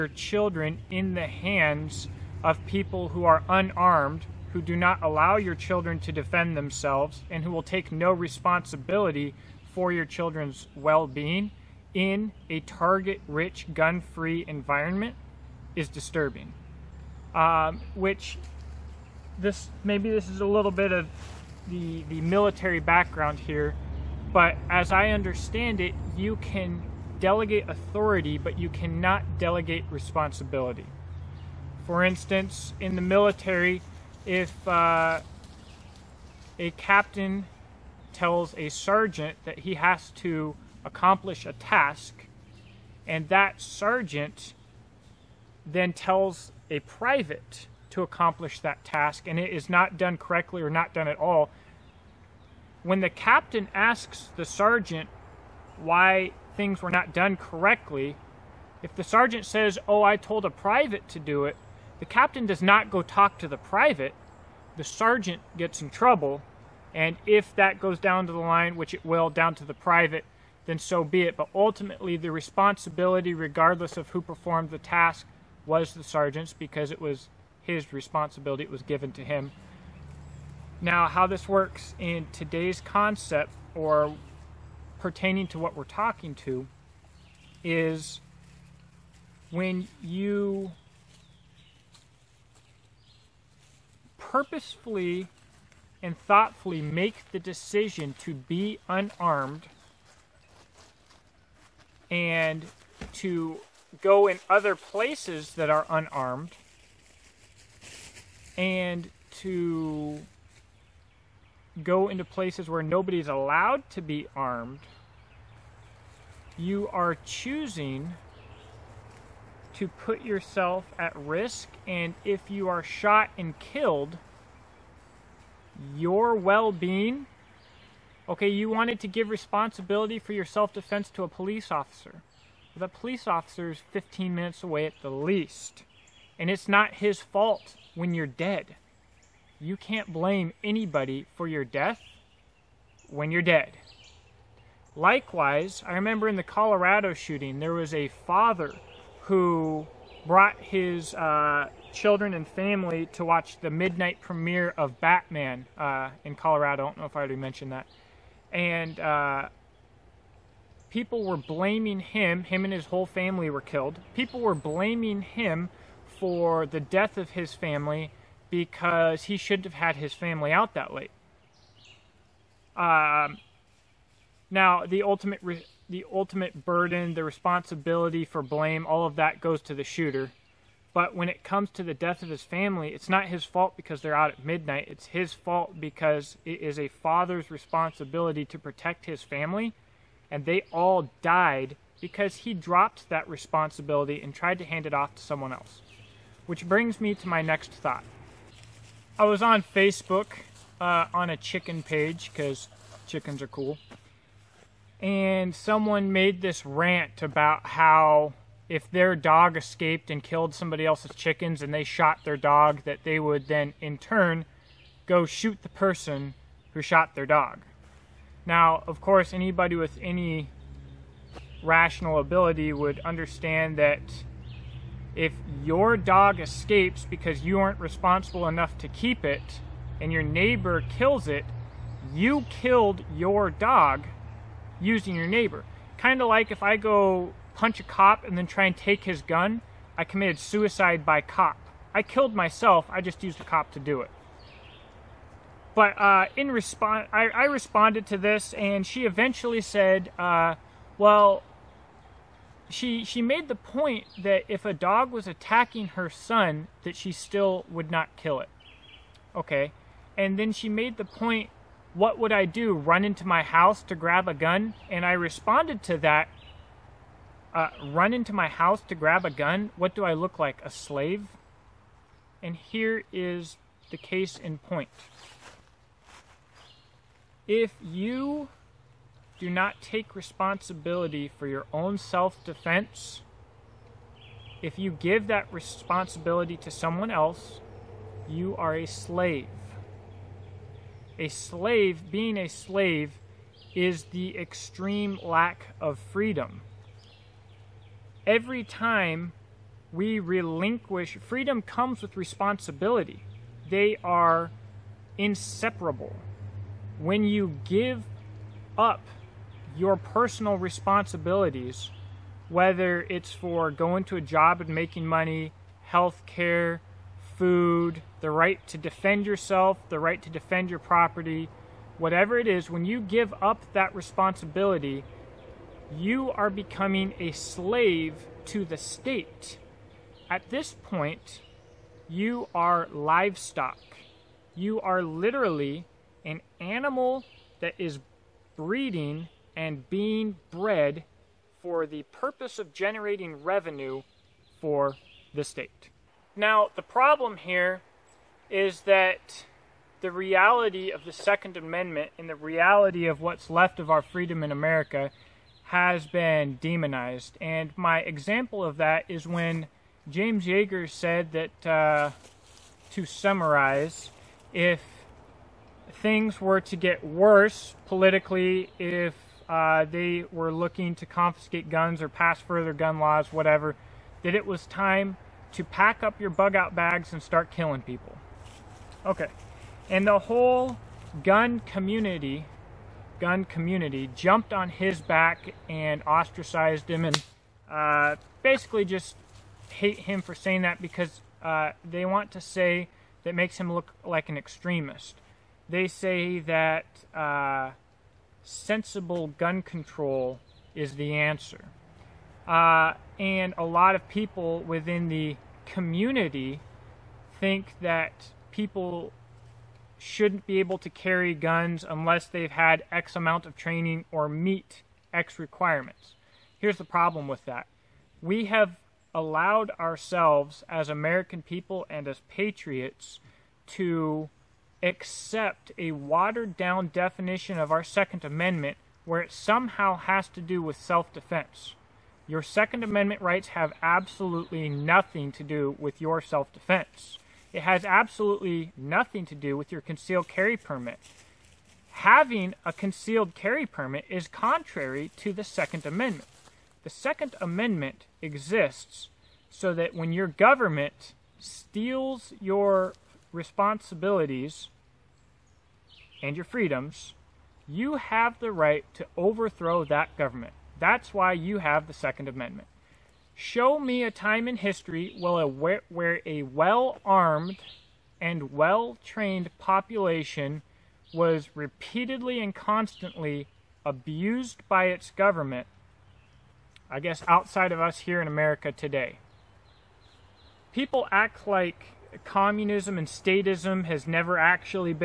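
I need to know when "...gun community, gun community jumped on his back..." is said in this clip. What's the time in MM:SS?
06:21.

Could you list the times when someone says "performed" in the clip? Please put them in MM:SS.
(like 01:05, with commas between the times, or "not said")
01:14.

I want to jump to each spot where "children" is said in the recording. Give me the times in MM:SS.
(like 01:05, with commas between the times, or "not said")
00:00, 00:05, 00:10, 02:31.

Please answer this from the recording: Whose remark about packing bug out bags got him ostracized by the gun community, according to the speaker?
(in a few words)
James Yeager.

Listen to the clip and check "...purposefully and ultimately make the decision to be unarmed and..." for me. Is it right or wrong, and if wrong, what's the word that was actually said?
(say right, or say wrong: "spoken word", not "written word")
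wrong: "thoughtfully", not "ultimately".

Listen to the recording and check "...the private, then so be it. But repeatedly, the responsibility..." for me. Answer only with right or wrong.
wrong.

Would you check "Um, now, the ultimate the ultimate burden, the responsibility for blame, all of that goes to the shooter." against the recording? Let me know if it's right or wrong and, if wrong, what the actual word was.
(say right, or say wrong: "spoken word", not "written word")
right.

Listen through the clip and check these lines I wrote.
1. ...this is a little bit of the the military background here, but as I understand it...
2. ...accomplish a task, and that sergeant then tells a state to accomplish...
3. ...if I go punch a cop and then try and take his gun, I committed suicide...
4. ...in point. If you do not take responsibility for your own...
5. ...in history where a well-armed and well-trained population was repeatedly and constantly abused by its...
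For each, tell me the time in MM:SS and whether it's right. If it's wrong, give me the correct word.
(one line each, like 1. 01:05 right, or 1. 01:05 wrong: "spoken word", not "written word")
1. 00:20 right
2. 00:40 wrong: "private", not "state"
3. 03:56 right
4. 04:34 right
5. 07:44 right.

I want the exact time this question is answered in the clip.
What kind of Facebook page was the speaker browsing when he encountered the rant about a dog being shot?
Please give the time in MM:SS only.
03:21.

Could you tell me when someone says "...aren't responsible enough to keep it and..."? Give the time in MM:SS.
03:47.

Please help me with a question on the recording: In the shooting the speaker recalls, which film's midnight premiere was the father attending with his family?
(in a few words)
Batman.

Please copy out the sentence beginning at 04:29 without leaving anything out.
What do I look like, a slave?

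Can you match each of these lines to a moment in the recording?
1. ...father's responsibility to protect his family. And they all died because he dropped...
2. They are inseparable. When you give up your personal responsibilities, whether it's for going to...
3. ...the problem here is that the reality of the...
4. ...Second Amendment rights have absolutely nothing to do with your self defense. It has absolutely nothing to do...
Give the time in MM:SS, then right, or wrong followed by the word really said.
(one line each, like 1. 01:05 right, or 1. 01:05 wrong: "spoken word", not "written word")
1. 03:06 right
2. 05:03 right
3. 05:46 right
4. 07:12 right.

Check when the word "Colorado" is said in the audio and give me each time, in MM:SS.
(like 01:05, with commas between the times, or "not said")
02:26, 02:36.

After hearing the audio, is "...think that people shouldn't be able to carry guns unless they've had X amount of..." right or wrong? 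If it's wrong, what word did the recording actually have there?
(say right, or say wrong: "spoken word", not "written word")
right.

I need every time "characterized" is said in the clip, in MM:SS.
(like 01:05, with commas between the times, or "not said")
not said.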